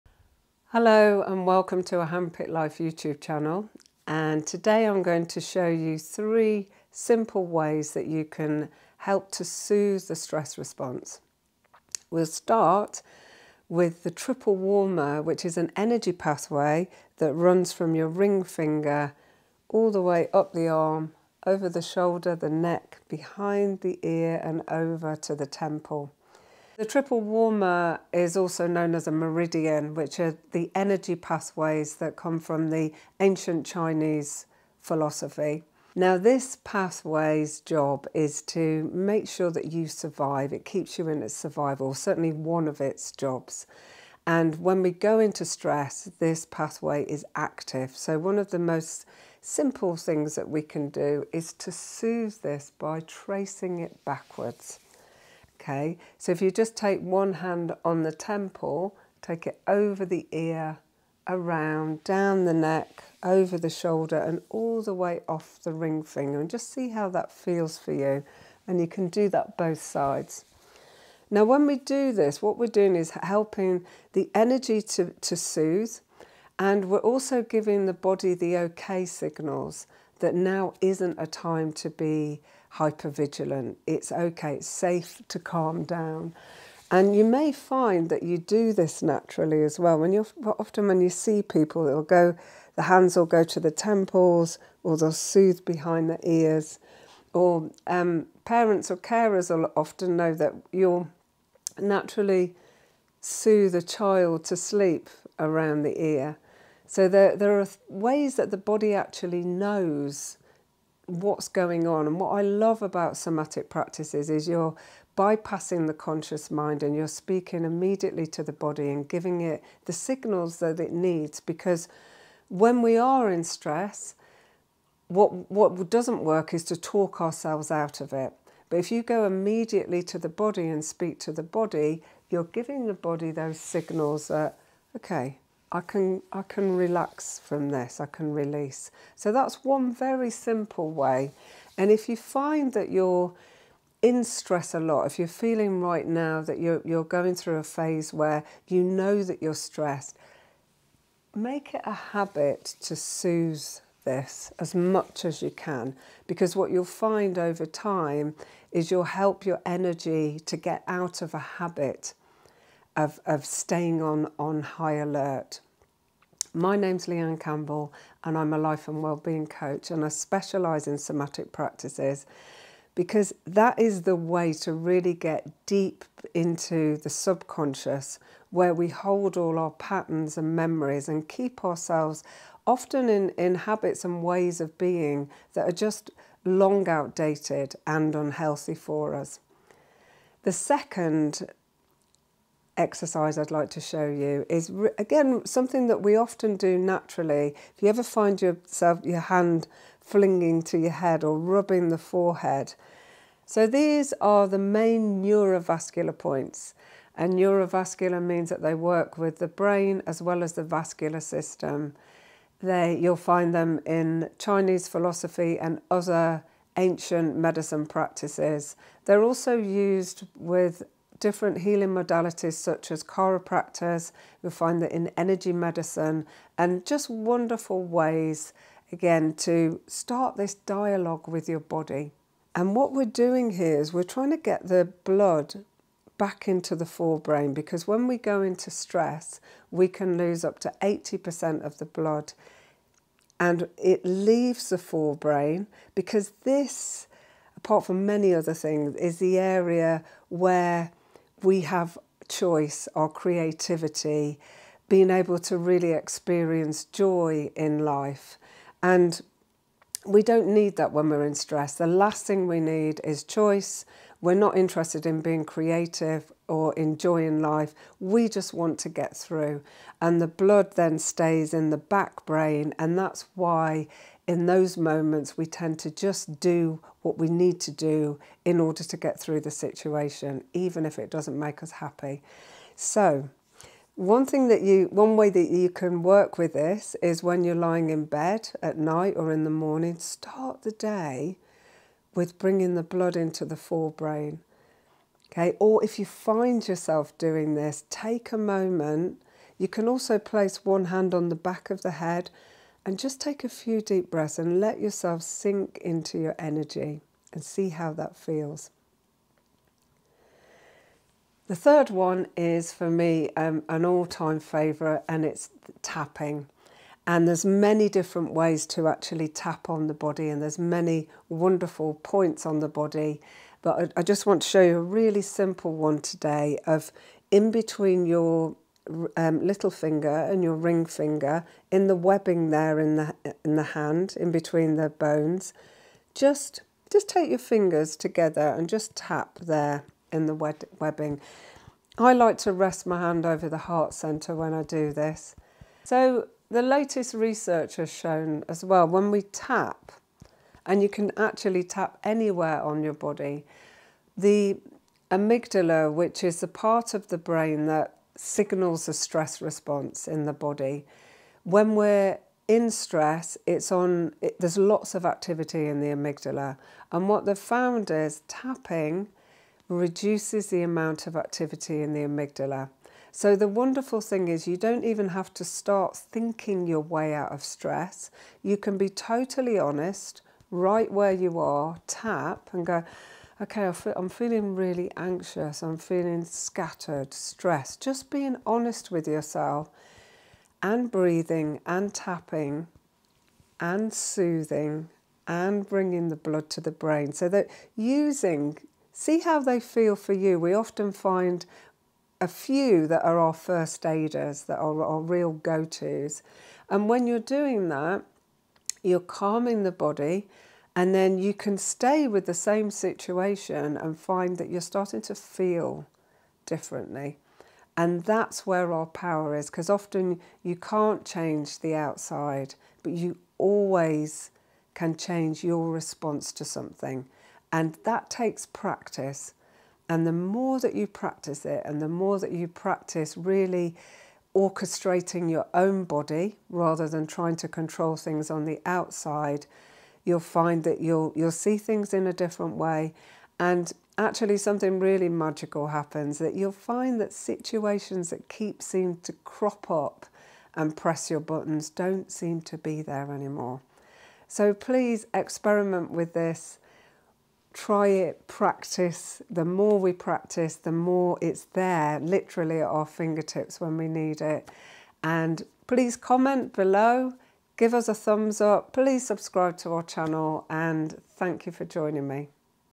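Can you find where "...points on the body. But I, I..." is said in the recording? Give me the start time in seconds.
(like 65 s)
322 s.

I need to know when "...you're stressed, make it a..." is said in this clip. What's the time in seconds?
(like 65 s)
149 s.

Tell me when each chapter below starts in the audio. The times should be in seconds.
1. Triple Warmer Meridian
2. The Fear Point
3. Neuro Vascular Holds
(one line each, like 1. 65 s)
1. 11 s
2. 311 s
3. 188 s.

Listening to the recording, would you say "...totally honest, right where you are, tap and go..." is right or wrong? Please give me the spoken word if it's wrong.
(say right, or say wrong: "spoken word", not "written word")
right.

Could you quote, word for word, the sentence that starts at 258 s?
And we don't need that when we're in stress.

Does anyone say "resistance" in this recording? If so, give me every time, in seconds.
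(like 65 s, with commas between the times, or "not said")
not said.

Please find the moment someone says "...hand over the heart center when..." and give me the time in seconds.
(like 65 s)
342 s.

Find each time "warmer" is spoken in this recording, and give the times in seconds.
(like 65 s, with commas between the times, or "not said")
14 s, 27 s.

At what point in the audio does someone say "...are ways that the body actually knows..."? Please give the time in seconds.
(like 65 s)
107 s.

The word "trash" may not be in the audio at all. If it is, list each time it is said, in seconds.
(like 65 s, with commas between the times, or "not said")
not said.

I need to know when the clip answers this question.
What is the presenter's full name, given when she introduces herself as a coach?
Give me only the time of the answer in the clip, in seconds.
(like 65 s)
167 s.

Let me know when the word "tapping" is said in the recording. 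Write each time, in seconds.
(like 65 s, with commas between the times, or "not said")
315 s, 368 s, 391 s.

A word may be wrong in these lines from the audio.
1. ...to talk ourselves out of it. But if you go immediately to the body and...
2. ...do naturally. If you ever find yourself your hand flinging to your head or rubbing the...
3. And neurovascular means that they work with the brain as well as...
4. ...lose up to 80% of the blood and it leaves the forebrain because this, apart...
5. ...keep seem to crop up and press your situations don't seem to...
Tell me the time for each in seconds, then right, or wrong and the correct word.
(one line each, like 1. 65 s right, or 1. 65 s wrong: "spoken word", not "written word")
1. 126 s right
2. 196 s right
3. 207 s right
4. 240 s right
5. 448 s wrong: "buttons", not "situations".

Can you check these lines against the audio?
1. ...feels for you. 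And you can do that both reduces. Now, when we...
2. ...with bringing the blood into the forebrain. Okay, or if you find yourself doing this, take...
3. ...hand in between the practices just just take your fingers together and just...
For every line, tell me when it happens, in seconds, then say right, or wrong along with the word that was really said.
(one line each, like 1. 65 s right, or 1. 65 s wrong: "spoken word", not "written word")
1. 67 s wrong: "sides", not "reduces"
2. 292 s right
3. 333 s wrong: "bones", not "practices".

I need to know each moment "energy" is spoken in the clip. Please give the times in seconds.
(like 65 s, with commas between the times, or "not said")
15 s, 30 s, 74 s, 159 s, 225 s, 306 s.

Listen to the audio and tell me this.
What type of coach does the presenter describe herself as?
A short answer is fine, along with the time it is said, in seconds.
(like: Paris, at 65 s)
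Life and wellbeing coach, at 168 s.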